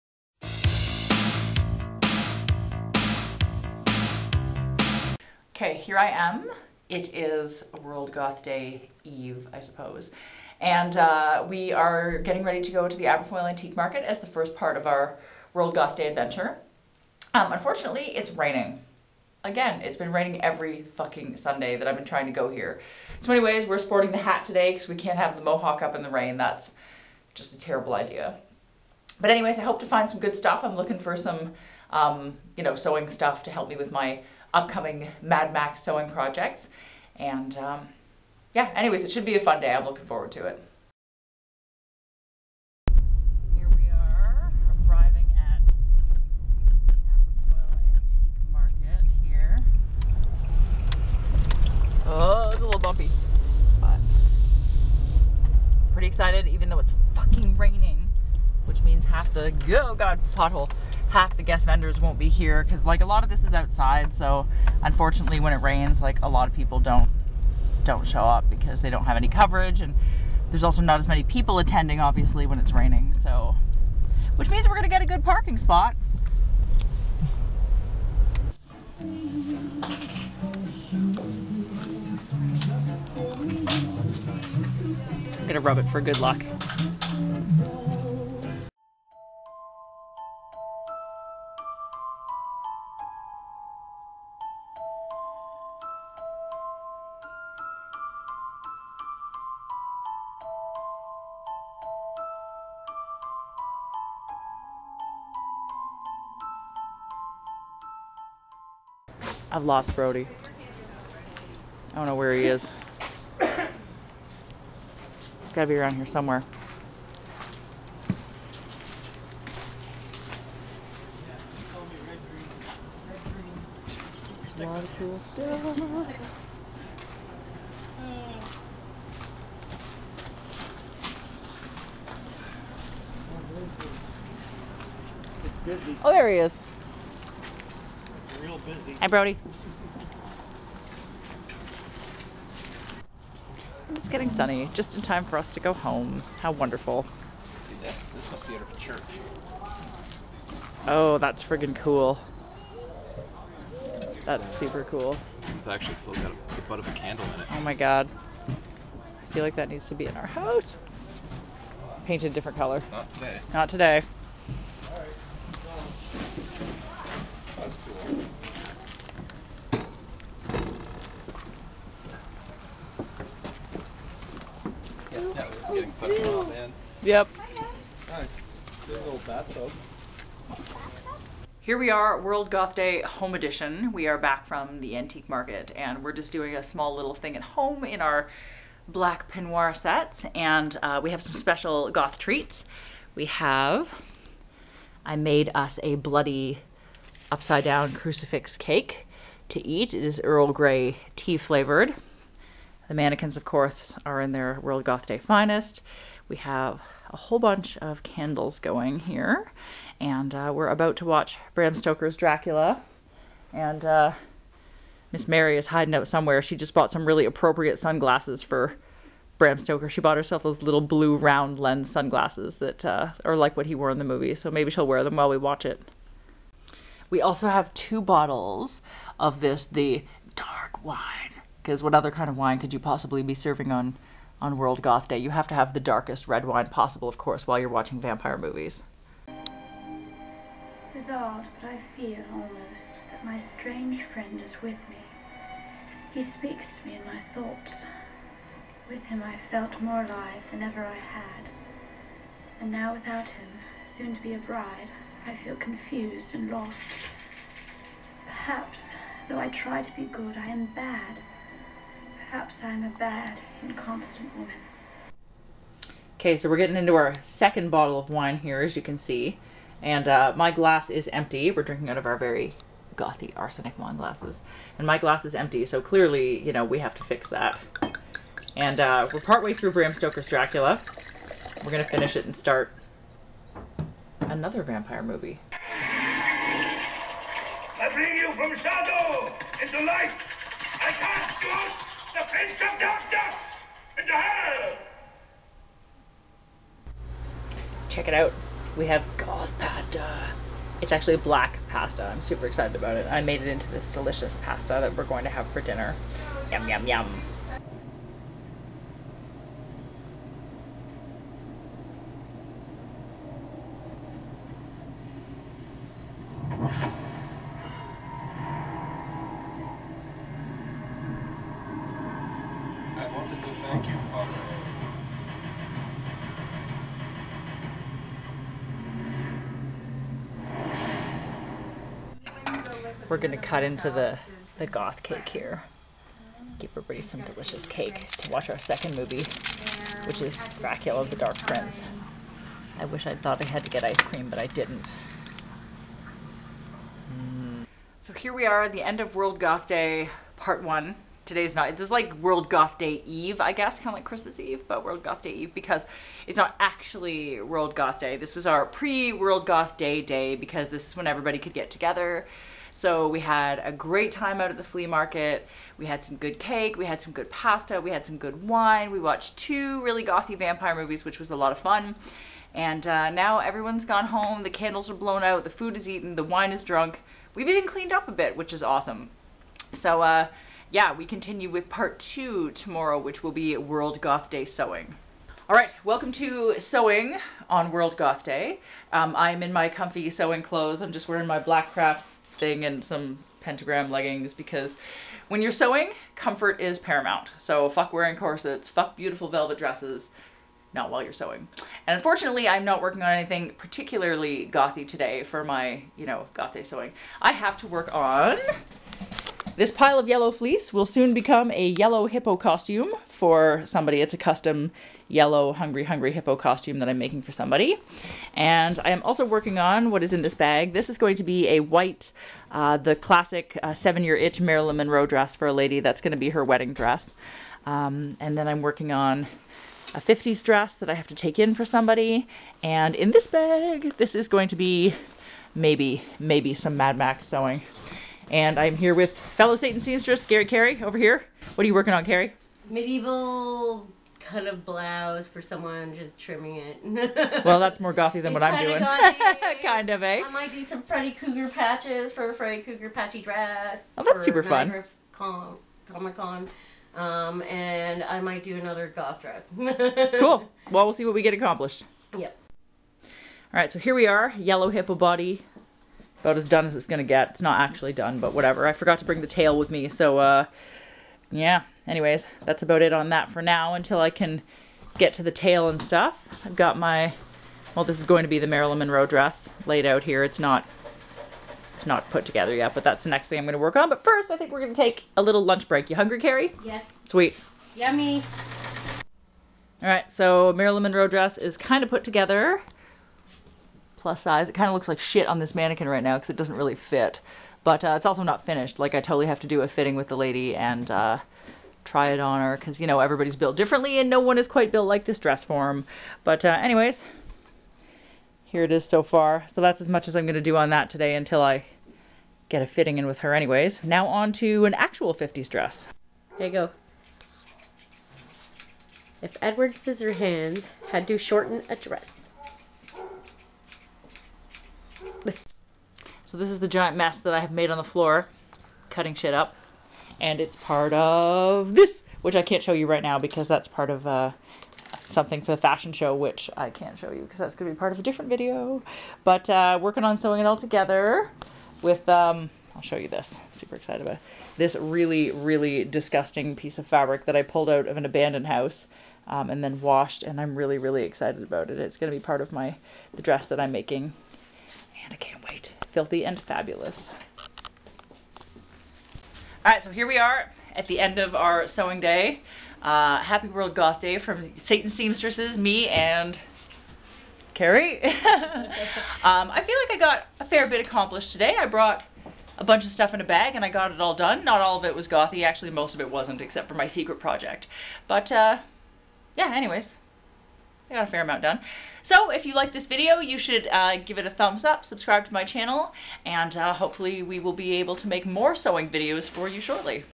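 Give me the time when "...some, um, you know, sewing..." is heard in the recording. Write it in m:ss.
0:31.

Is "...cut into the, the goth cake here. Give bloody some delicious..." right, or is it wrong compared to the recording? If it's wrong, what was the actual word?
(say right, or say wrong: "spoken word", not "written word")
wrong: "everybody", not "bloody".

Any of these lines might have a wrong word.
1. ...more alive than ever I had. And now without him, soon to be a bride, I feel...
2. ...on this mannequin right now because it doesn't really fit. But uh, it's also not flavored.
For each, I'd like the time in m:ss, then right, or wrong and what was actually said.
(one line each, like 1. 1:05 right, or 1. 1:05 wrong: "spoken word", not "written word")
1. 4:09 right
2. 8:15 wrong: "finished", not "flavored".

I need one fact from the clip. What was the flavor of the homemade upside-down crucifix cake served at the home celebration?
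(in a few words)
Earl Grey tea.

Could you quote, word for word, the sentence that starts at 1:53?
he has gotta be around here somewhere.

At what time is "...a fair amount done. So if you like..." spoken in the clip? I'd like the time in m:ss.
9:41.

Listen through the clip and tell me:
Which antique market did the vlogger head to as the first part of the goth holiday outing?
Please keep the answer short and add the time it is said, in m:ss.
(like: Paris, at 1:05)
Aberfoyle Antique Market, at 0:13.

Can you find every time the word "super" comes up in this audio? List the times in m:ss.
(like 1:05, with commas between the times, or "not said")
2:34, 5:02, 7:34, 9:03.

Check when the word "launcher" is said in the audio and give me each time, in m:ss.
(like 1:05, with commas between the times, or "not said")
not said.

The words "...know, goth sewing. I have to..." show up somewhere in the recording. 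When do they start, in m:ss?
6:46.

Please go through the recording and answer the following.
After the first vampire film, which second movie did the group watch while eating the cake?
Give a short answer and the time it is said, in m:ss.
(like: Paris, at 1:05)
Dracula the Dark Prince, at 5:40.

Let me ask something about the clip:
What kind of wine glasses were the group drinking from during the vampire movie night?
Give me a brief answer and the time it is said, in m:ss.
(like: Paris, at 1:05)
arsenic wine glasses, at 4:33.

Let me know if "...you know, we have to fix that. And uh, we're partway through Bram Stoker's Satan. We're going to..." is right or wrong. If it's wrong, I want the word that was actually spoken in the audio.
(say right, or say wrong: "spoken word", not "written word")
wrong: "Dracula", not "Satan".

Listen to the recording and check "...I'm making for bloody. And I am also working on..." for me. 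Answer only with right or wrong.
wrong.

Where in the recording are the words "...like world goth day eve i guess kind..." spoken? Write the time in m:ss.
5:51.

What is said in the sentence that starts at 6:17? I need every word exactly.
We've even cleaned up a bit, which is awesome.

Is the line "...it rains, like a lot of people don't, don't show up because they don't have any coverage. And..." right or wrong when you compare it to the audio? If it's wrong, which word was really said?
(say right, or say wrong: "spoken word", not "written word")
right.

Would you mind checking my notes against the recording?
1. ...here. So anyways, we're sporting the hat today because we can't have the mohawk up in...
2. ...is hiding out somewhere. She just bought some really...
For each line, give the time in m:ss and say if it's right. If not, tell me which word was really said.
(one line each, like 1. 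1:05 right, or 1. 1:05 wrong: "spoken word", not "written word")
1. 0:22 right
2. 3:35 right.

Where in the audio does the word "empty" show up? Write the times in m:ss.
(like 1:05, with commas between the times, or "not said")
4:31, 4:35.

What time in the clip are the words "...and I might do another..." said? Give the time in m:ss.
7:37.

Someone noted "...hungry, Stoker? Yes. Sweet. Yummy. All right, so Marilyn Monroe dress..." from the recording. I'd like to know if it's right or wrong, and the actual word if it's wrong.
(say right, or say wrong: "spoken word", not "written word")
wrong: "Carrie", not "Stoker".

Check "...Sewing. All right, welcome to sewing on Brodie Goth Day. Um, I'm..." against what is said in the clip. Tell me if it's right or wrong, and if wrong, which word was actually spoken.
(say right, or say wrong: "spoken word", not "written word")
wrong: "World", not "Brodie".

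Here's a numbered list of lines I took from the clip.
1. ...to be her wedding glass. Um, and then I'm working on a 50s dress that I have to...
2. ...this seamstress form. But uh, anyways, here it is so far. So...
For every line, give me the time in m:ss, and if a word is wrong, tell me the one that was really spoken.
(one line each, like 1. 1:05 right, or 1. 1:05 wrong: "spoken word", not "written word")
1. 7:06 wrong: "dress", not "glass"
2. 8:25 wrong: "dress", not "seamstress".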